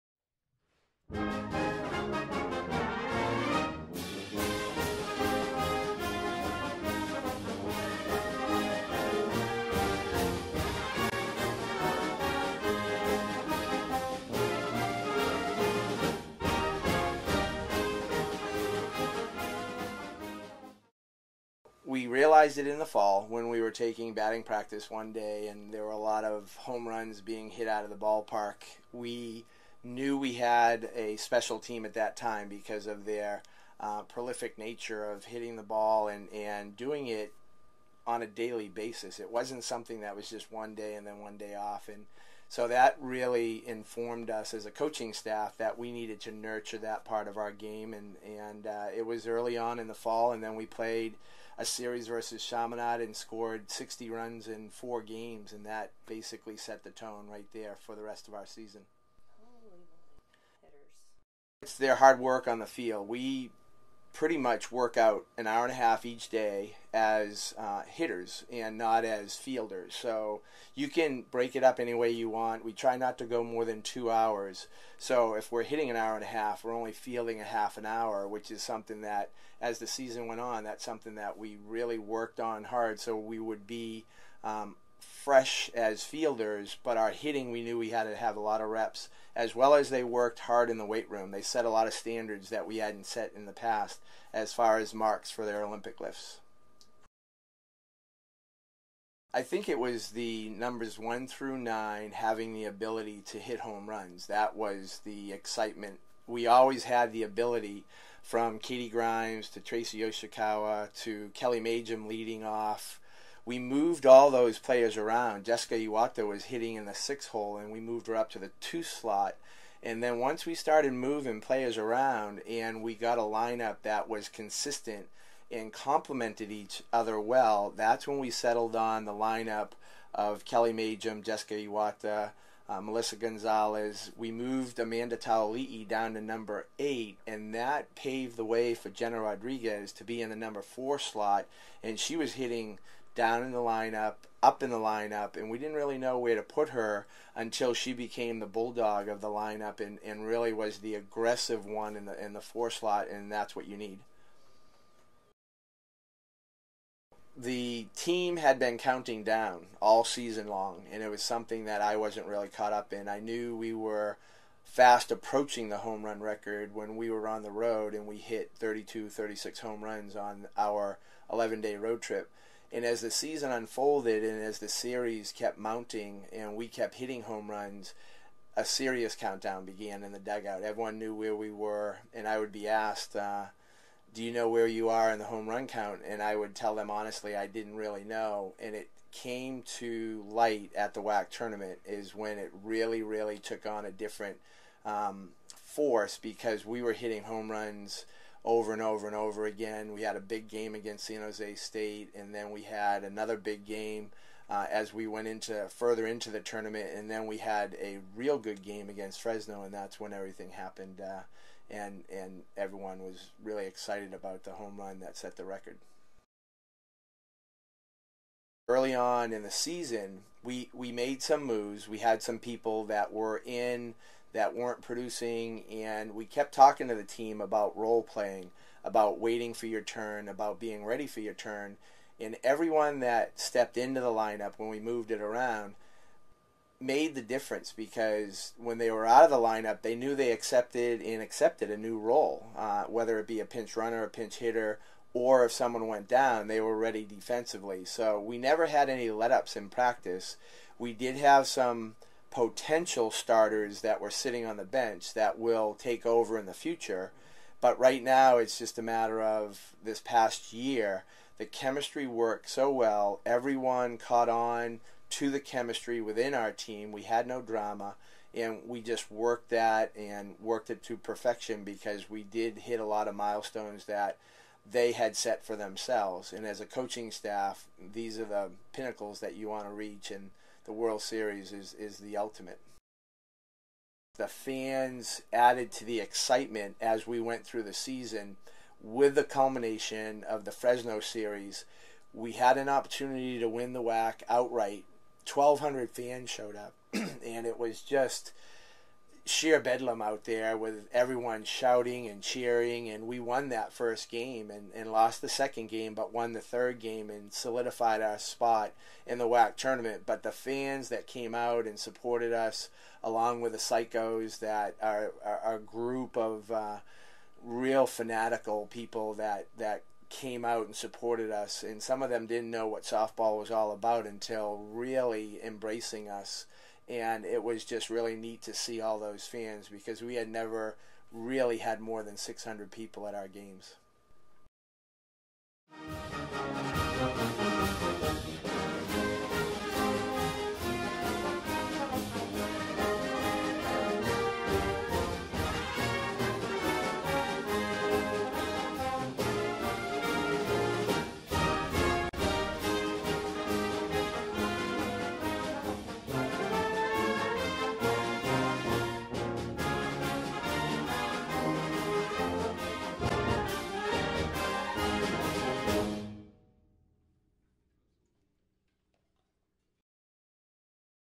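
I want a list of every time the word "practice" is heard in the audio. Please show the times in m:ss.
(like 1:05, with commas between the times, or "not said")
0:24, 4:09.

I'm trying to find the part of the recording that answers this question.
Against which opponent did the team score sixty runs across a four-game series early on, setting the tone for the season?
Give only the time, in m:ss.
0:52.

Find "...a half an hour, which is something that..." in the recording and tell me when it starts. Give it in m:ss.
1:17.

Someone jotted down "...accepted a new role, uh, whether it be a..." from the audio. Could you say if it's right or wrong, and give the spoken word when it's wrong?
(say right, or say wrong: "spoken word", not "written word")
right.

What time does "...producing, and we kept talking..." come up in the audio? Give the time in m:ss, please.
3:44.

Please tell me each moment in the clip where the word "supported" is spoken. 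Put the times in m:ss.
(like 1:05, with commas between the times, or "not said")
5:11, 5:20.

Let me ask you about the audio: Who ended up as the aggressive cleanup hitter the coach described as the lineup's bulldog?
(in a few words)
Jenna Rodriguez.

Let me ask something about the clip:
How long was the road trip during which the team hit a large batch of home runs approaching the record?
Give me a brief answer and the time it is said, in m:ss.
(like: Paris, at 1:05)
11 days, at 2:51.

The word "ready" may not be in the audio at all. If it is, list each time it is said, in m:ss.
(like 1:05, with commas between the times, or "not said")
3:50, 4:06.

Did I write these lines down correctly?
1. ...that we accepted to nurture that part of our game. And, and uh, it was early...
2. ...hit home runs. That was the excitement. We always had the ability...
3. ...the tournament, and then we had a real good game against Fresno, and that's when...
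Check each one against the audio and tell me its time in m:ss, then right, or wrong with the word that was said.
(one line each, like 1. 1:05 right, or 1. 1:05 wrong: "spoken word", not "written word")
1. 0:45 wrong: "needed", not "accepted"
2. 1:43 right
3. 3:26 right.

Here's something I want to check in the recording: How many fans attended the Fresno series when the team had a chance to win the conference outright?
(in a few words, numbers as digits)
1,200.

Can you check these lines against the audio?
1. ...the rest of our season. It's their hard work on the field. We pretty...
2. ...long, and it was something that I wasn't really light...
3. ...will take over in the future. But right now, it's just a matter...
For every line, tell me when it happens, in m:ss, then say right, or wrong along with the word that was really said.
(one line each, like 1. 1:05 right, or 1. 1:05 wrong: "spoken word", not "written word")
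1. 0:57 right
2. 2:40 wrong: "caught", not "light"
3. 4:15 right.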